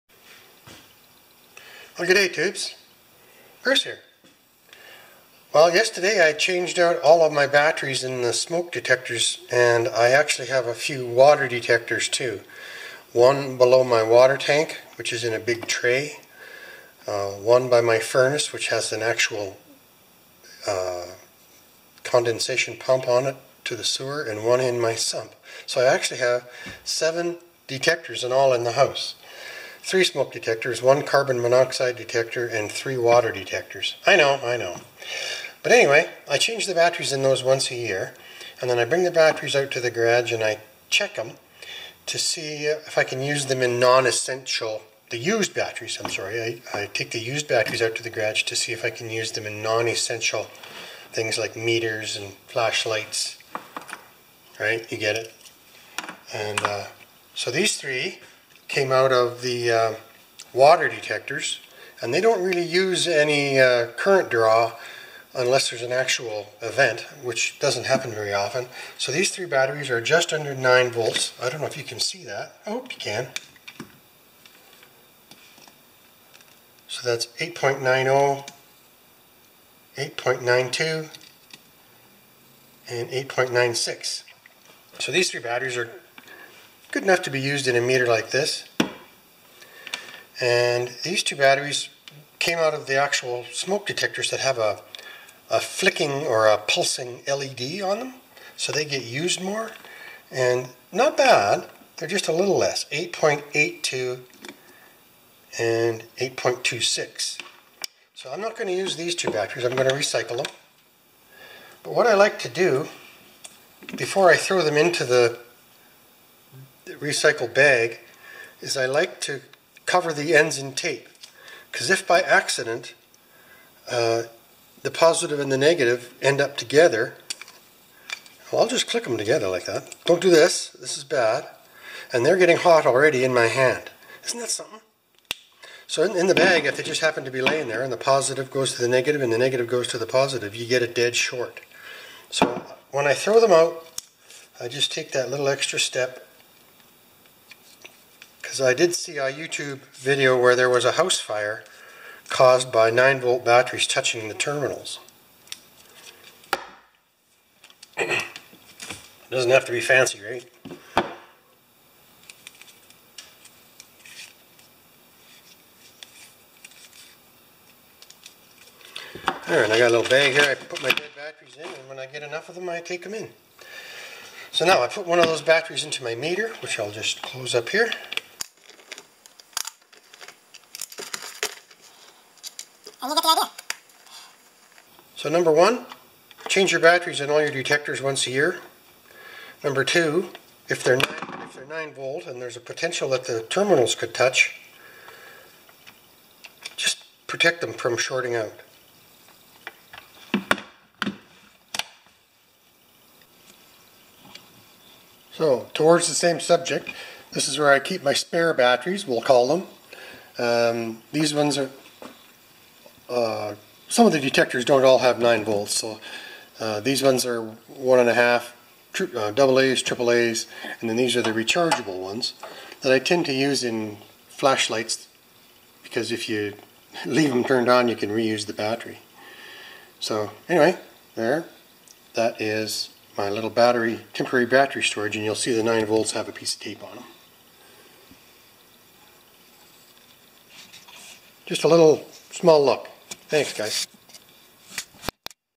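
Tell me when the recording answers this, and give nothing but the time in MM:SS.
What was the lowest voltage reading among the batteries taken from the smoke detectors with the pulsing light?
01:46.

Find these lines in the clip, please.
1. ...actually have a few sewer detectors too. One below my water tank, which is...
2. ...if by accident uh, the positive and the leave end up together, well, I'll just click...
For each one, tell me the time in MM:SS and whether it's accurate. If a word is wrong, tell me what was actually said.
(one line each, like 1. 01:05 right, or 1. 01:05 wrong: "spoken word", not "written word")
1. 00:10 wrong: "water", not "sewer"
2. 02:01 wrong: "negative", not "leave".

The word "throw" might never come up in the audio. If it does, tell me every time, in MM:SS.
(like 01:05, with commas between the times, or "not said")
01:54, 02:23.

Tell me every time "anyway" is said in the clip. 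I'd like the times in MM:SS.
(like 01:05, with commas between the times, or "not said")
00:35, 03:50.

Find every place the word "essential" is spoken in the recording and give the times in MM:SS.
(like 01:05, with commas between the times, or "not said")
00:43, 00:49.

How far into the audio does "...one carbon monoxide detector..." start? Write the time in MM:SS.
00:30.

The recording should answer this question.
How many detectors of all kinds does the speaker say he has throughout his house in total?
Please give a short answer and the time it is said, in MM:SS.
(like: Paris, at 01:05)
7, at 00:26.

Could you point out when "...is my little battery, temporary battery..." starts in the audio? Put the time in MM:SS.
03:52.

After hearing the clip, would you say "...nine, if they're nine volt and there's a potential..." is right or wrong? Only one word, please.
right.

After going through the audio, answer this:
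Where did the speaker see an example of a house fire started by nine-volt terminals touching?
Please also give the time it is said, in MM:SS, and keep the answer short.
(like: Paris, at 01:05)
YouTube video, at 02:29.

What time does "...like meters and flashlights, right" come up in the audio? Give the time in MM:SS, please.
00:51.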